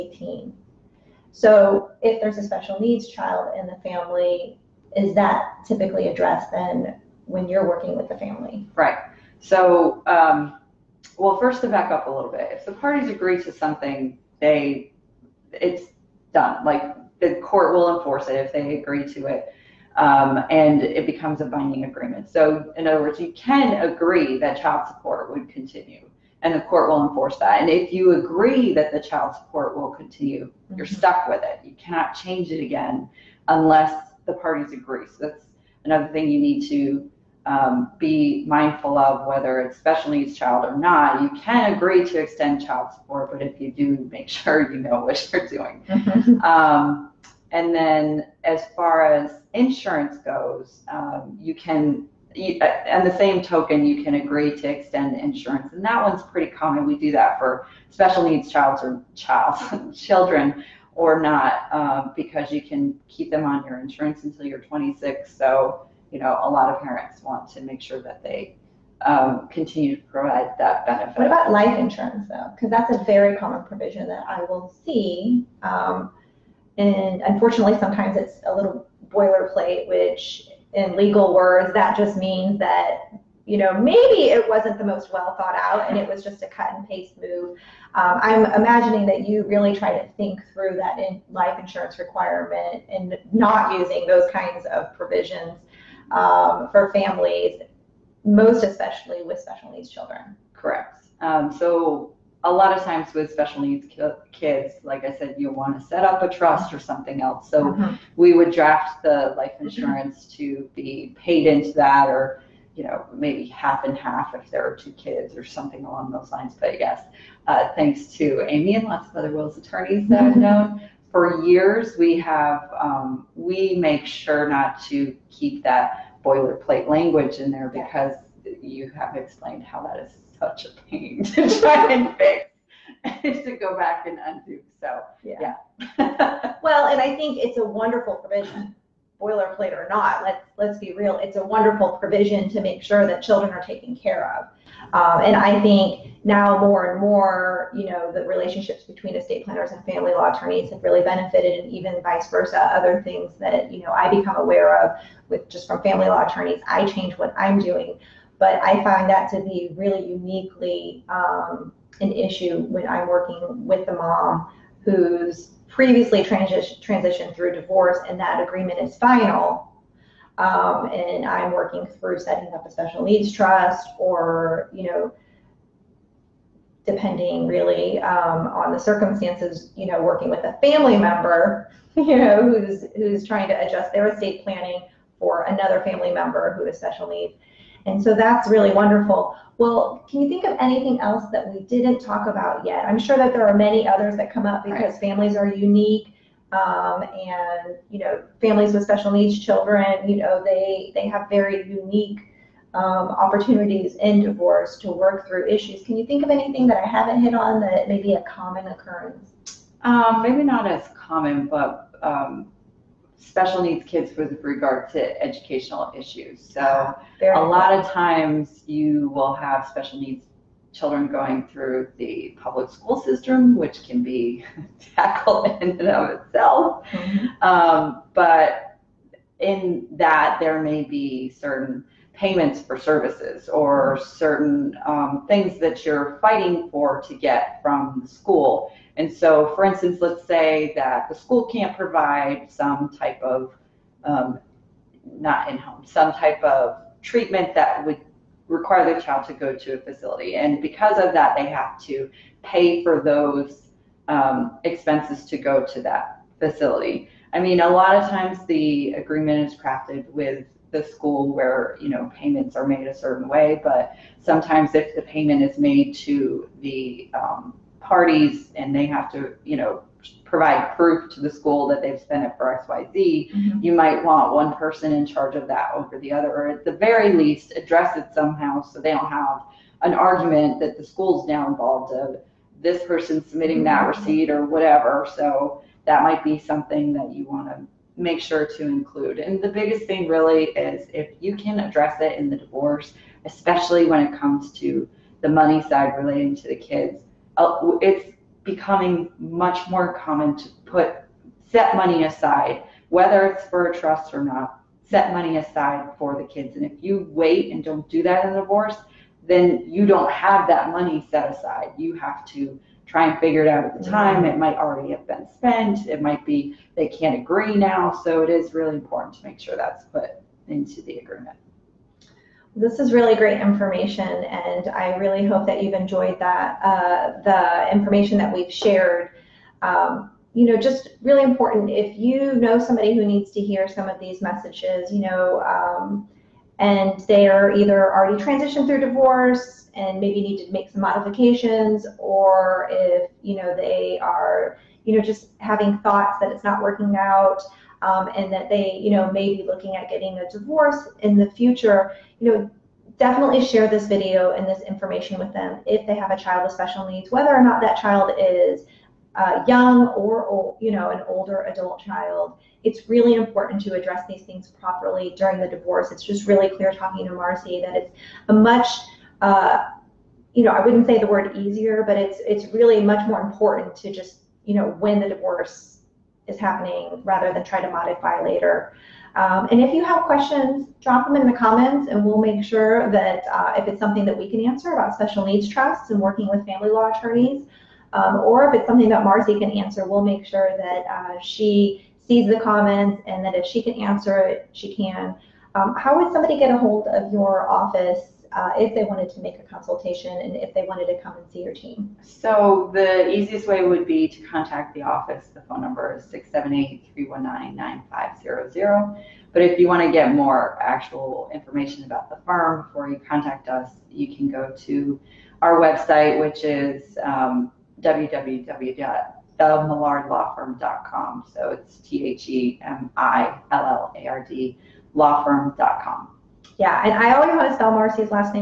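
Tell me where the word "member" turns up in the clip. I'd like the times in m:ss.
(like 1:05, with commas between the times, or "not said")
3:00, 3:06.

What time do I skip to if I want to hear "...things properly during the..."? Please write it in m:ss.
6:04.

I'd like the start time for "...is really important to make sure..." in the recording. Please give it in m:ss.
5:18.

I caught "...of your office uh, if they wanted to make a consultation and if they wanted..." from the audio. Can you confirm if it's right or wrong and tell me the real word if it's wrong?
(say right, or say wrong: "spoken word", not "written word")
right.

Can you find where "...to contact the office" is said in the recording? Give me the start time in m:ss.
6:44.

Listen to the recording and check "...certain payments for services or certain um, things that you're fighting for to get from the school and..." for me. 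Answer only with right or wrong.
right.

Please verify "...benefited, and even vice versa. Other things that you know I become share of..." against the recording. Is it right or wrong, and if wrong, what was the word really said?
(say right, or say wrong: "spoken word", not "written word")
wrong: "aware", not "share".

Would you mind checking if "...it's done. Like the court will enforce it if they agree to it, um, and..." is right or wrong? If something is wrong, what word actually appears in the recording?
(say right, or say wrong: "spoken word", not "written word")
right.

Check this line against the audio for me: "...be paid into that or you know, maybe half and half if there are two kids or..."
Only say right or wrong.
right.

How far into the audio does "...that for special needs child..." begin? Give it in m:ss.
0:57.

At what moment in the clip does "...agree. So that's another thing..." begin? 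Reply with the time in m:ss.
0:34.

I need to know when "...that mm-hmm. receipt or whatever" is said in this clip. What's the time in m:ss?
4:43.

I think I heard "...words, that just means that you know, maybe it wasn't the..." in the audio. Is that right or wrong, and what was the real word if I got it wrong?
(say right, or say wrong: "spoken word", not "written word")
right.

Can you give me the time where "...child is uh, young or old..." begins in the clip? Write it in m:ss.
5:57.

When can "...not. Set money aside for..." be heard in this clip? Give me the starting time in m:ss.
5:04.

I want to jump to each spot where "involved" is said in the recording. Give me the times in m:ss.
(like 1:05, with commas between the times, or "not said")
4:41.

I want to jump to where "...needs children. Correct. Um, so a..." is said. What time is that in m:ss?
1:39.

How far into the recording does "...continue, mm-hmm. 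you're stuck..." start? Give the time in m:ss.
0:29.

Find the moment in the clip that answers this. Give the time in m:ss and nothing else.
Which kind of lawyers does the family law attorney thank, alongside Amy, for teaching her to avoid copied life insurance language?
1:59.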